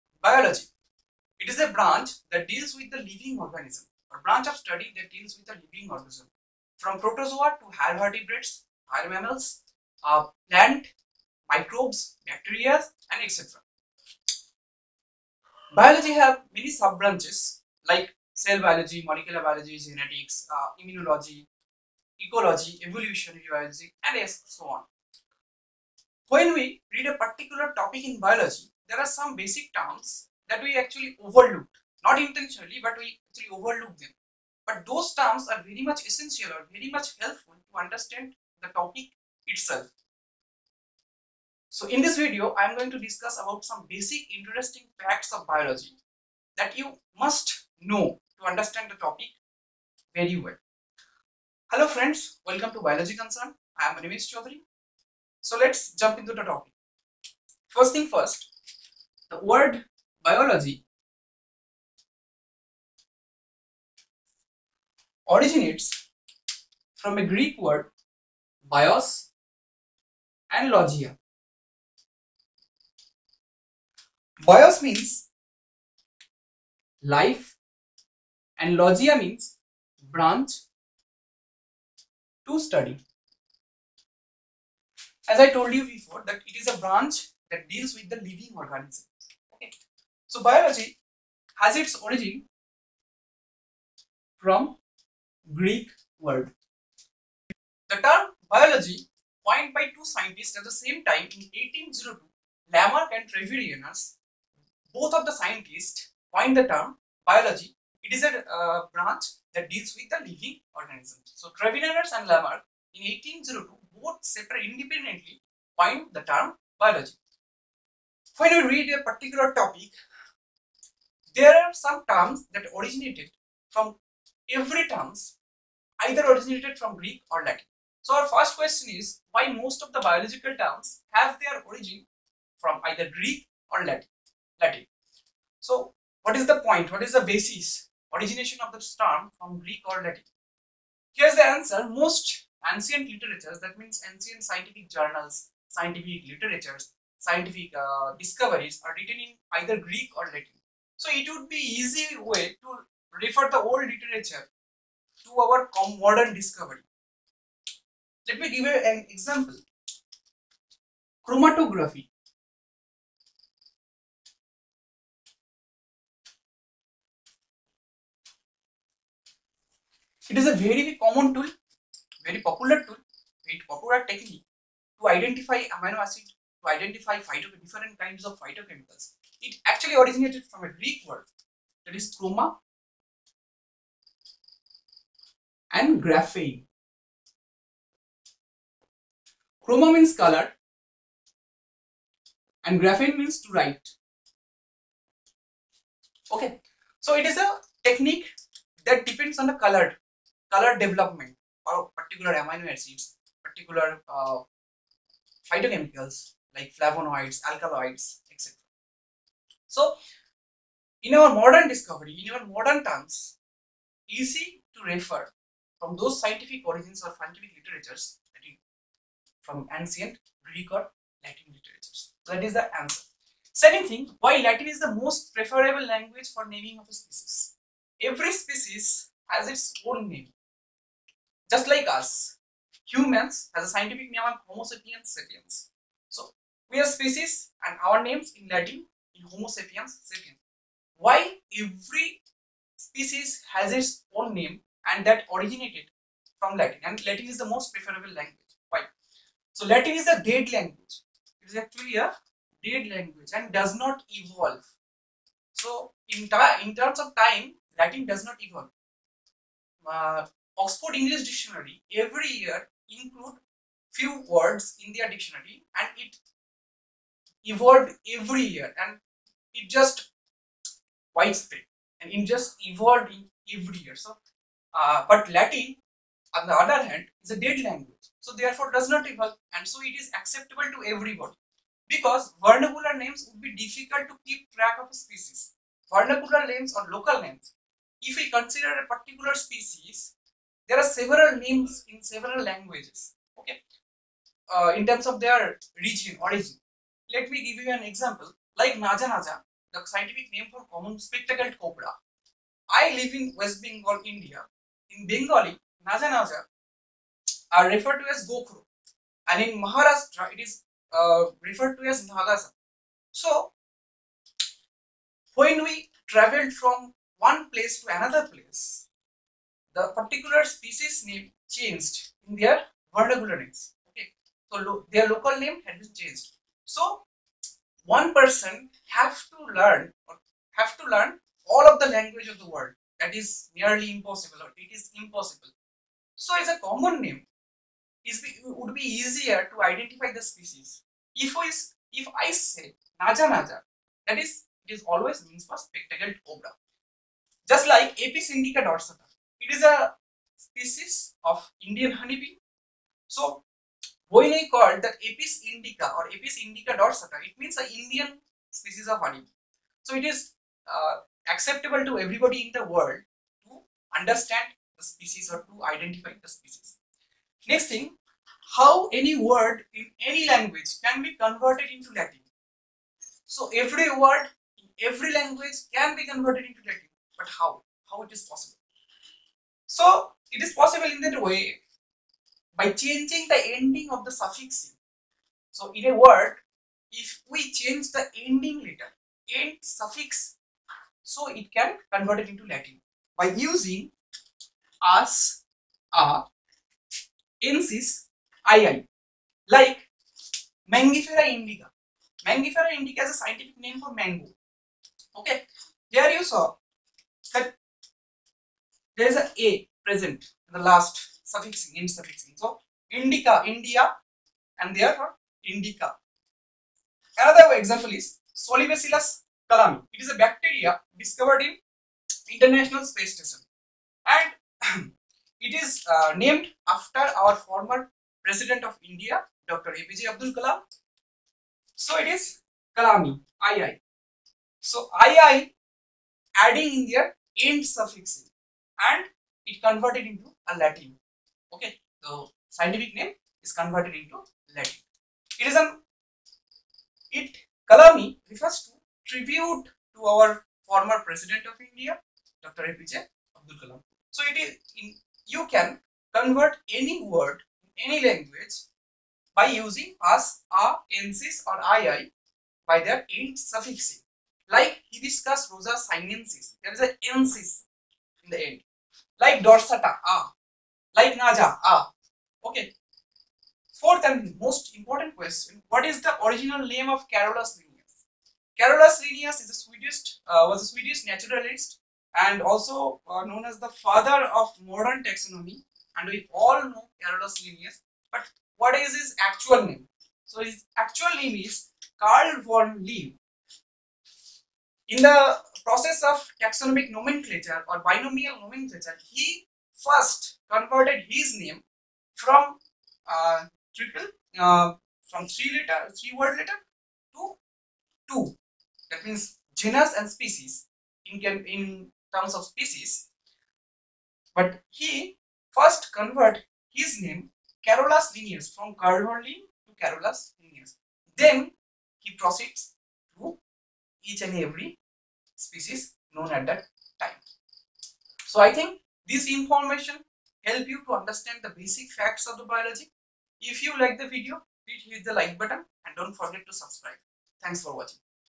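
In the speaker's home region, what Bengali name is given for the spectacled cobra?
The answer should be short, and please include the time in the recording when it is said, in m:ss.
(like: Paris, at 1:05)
Gokro, at 5:08.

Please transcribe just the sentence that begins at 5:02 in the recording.
I live in West Bengal, India.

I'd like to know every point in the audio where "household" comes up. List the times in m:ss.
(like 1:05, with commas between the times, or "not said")
not said.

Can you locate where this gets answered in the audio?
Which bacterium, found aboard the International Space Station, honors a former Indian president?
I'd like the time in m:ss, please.
6:58.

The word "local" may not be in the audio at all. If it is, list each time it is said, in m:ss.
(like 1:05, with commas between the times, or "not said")
4:46, 5:25.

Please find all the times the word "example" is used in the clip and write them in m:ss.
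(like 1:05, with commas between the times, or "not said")
2:39, 4:57, 6:57.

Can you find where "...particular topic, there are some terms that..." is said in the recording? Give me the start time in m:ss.
1:59.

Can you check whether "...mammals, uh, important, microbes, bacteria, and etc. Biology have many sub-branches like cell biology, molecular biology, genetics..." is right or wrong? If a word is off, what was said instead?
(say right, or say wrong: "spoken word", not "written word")
wrong: "plant", not "important".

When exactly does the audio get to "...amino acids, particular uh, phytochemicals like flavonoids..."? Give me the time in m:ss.
3:22.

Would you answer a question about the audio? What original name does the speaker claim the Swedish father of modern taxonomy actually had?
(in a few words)
Carl von Linnaeus.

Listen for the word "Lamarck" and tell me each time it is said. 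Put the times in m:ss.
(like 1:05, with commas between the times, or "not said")
1:42, 1:52.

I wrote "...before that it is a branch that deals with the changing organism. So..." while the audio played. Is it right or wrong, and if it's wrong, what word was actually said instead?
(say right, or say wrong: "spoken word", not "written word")
wrong: "living", not "changing".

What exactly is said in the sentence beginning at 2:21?
Most ancient literatures, that means ancient scientific journals, scientific literatures, scientific uh, discoveries are written in either Greek or Latin.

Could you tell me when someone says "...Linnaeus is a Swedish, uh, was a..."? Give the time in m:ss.
7:59.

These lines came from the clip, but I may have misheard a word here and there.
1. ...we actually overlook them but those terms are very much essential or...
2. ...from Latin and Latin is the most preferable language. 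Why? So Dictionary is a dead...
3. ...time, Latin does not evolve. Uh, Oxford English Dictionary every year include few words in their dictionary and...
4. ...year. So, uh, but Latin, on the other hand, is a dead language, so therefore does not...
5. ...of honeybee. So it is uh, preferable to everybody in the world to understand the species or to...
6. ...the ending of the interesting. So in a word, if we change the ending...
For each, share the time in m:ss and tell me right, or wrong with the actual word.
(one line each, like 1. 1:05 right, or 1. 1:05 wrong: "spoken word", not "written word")
1. 0:32 right
2. 4:06 wrong: "Latin", not "Dictionary"
3. 4:17 right
4. 4:33 right
5. 5:58 wrong: "acceptable", not "preferable"
6. 6:23 wrong: "suffixing", not "interesting".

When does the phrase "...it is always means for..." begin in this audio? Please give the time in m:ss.
5:44.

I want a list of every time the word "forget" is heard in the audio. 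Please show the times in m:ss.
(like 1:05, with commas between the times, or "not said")
8:56.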